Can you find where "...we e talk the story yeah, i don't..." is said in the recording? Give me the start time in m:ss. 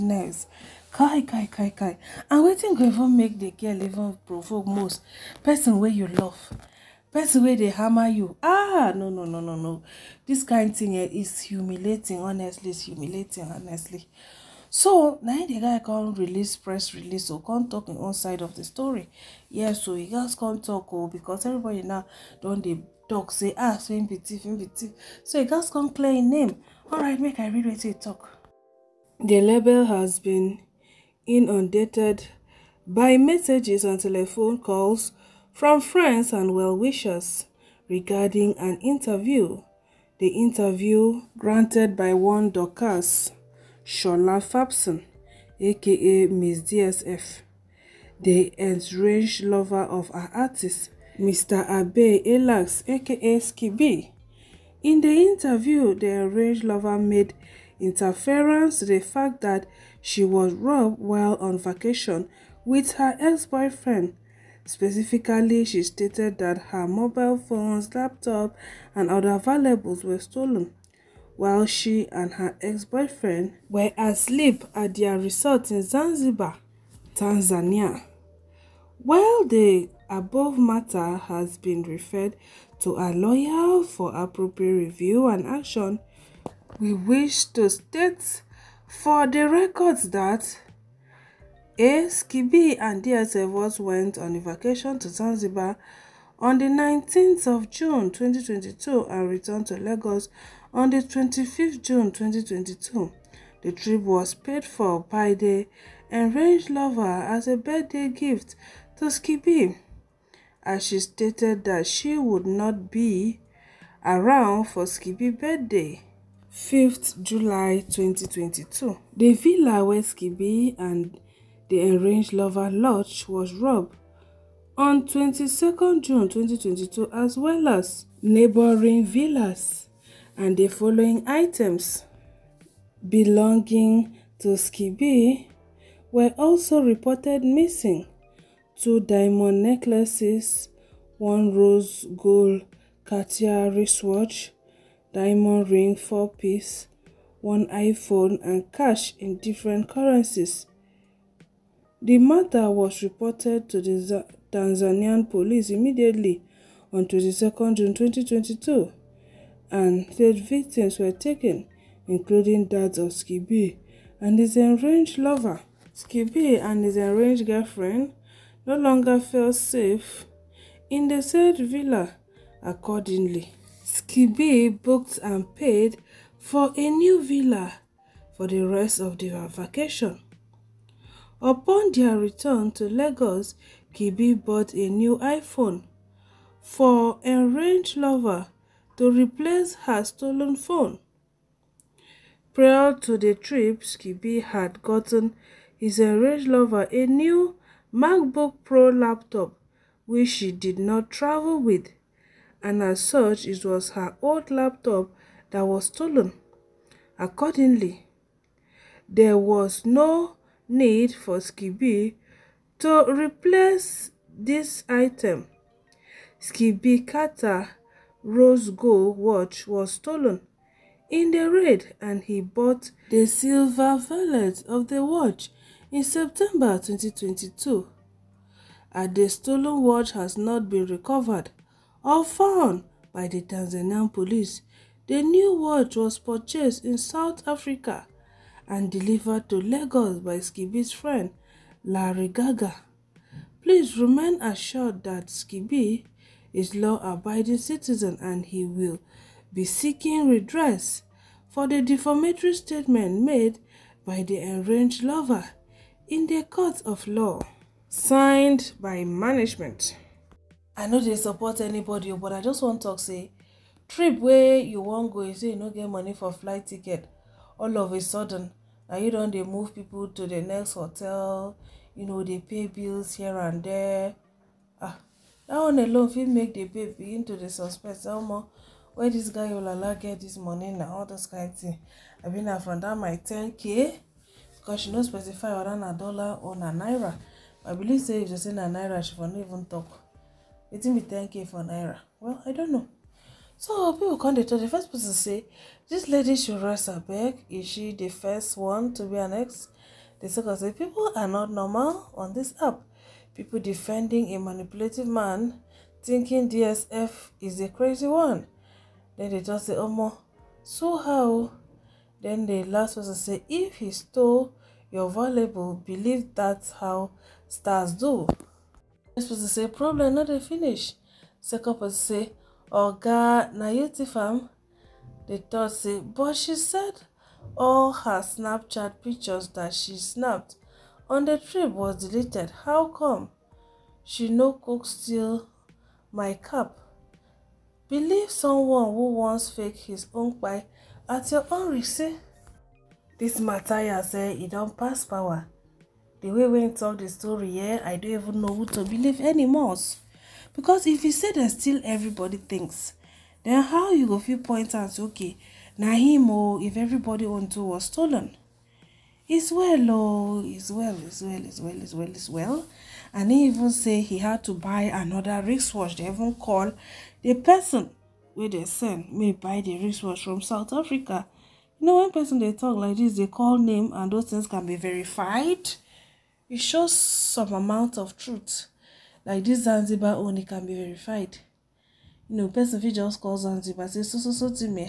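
5:46.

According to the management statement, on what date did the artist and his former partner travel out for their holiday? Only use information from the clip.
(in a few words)
19th of June 2022.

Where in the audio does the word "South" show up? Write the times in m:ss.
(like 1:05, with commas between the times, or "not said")
3:56, 6:10.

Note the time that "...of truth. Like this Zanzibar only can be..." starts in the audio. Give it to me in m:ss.
6:17.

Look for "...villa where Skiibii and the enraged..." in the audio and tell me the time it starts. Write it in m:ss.
1:59.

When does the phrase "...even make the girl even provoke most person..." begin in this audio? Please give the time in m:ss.
0:02.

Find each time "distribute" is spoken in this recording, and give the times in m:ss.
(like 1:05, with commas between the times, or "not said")
not said.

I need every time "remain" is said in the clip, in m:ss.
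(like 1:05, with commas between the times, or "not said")
4:03.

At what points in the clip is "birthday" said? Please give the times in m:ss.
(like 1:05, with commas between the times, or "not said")
1:47, 1:55.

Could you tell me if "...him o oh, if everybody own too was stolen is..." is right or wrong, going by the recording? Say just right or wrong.
right.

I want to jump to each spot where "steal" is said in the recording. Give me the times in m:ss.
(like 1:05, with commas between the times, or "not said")
5:34, 5:51.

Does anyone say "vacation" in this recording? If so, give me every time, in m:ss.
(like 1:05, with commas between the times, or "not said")
1:01, 1:34, 2:59.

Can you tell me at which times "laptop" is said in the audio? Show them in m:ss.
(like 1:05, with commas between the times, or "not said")
1:07, 3:18, 3:24.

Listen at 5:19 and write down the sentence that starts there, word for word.
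This person say, problem not a finish.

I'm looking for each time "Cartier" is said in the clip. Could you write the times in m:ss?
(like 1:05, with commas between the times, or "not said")
2:23, 3:37.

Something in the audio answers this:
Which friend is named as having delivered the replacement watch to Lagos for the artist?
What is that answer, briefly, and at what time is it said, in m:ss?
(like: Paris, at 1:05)
Larry Gaga, at 4:01.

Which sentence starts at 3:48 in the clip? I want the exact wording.
And the stolen watch has not been recovered or found by the Tanzanian police.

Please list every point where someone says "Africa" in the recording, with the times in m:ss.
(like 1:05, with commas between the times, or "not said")
3:57, 6:10.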